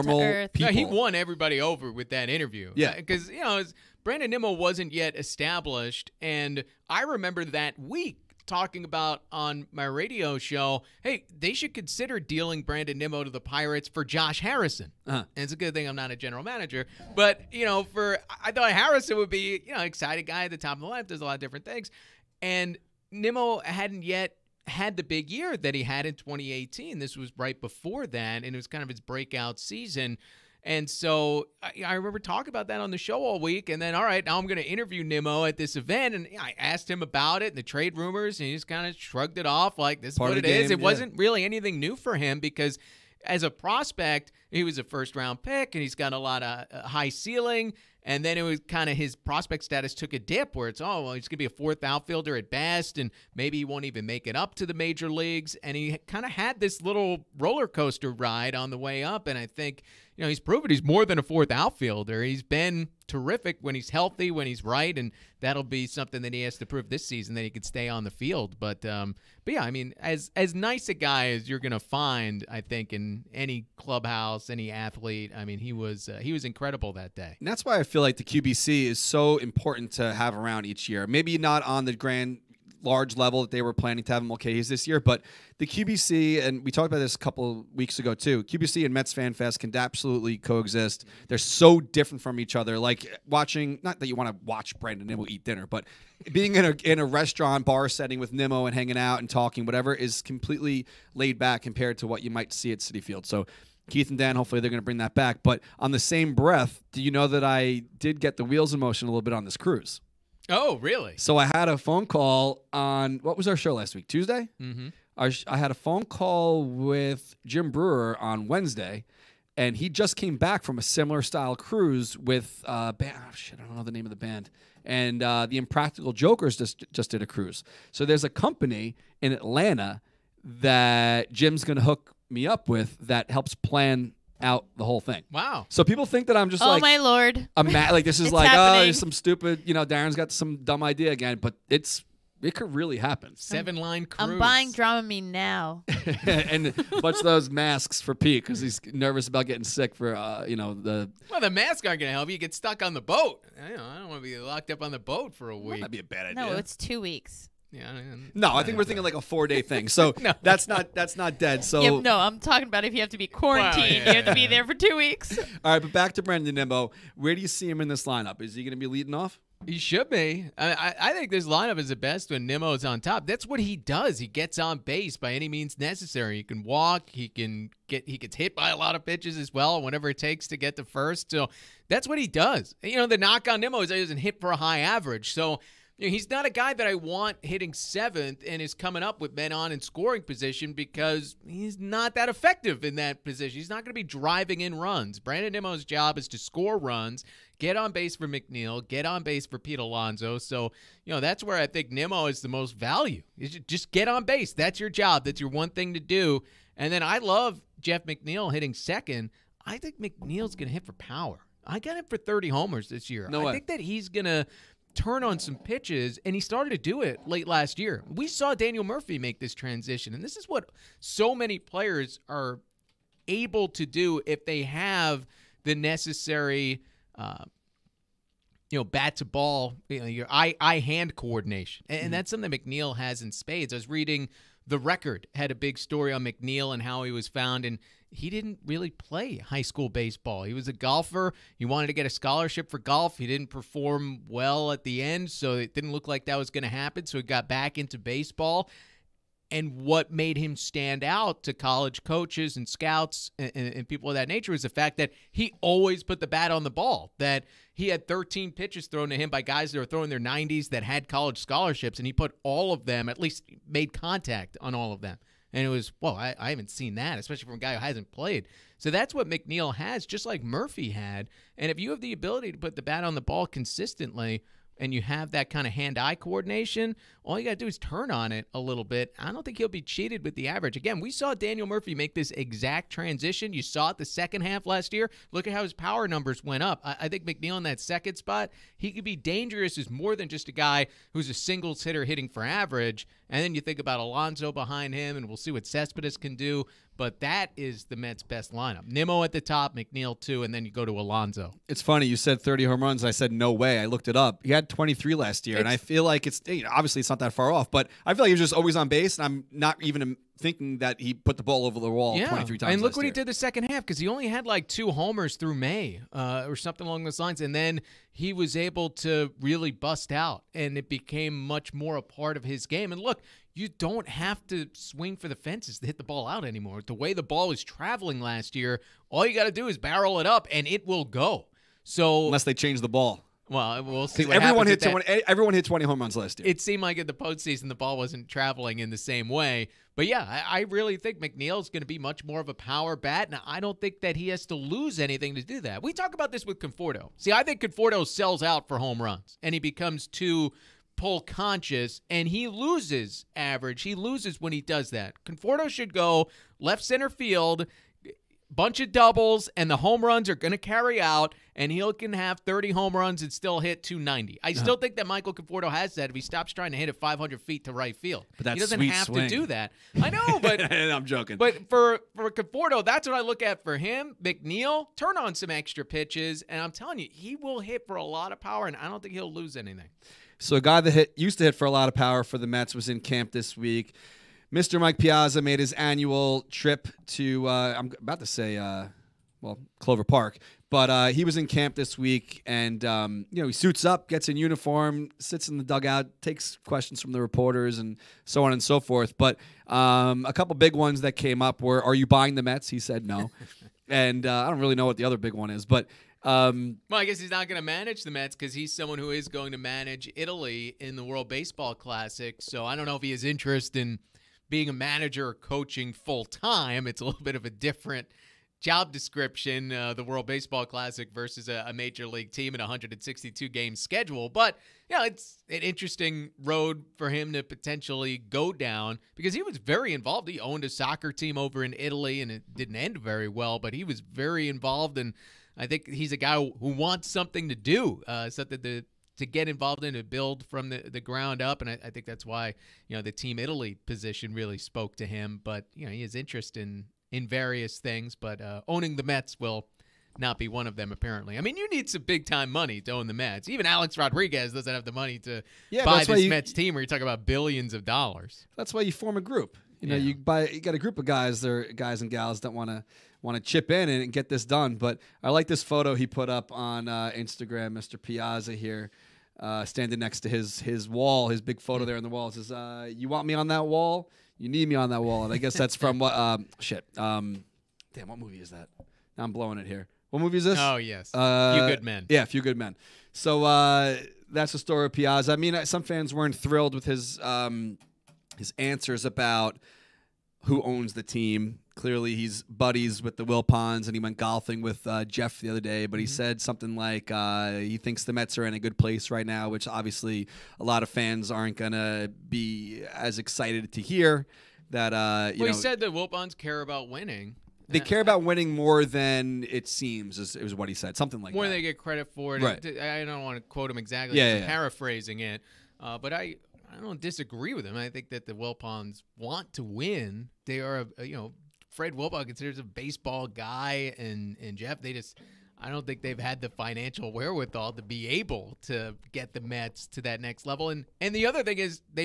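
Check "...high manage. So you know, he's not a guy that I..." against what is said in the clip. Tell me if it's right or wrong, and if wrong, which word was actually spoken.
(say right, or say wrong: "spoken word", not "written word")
wrong: "average", not "manage".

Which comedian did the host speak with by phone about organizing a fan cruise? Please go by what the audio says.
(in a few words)
Jim Breuer.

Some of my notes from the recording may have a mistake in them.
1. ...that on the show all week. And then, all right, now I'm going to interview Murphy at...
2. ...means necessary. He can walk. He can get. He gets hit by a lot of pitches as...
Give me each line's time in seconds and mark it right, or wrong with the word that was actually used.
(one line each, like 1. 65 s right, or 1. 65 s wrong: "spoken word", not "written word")
1. 32 s wrong: "Nimmo", not "Murphy"
2. 175 s right.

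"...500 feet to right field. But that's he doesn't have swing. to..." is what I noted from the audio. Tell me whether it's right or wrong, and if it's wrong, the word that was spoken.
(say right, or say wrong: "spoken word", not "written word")
right.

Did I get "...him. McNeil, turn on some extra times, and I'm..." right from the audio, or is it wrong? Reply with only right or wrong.
wrong.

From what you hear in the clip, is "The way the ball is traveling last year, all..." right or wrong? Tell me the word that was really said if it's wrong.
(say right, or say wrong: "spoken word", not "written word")
right.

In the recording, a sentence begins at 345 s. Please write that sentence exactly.
We talk about this with Conforto.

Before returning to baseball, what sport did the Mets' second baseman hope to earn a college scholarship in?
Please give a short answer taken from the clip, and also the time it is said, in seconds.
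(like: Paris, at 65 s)
Golf, at 242 s.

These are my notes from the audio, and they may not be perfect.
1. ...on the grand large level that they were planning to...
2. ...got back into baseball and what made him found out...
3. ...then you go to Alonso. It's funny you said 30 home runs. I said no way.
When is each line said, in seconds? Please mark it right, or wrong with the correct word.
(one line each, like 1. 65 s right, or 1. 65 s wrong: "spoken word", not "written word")
1. 81 s right
2. 247 s wrong: "stand", not "found"
3. 300 s right.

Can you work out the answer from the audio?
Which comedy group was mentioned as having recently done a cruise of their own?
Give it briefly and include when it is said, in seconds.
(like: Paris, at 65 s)
Impractical Jokers, at 125 s.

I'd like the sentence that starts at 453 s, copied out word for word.
Even Alex Rodriguez doesn't have the money to yeah, buy this you, Mets team, where you talk about billions of dollars.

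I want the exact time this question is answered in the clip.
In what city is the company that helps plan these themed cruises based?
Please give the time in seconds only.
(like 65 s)
129 s.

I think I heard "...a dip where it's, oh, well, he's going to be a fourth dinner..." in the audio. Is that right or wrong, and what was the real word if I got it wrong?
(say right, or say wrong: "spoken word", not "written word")
wrong: "outfielder", not "dinner".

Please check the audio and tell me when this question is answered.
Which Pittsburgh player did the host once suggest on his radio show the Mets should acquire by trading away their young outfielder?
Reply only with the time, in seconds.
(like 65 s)
14 s.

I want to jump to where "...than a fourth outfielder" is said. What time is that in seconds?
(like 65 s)
61 s.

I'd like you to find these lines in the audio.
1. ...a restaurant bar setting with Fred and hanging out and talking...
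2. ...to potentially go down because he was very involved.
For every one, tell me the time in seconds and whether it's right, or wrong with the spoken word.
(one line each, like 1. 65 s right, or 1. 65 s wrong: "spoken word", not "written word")
1. 96 s wrong: "Nimmo", not "Fred"
2. 427 s right.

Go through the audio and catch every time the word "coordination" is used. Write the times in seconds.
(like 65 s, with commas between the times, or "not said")
231 s, 276 s.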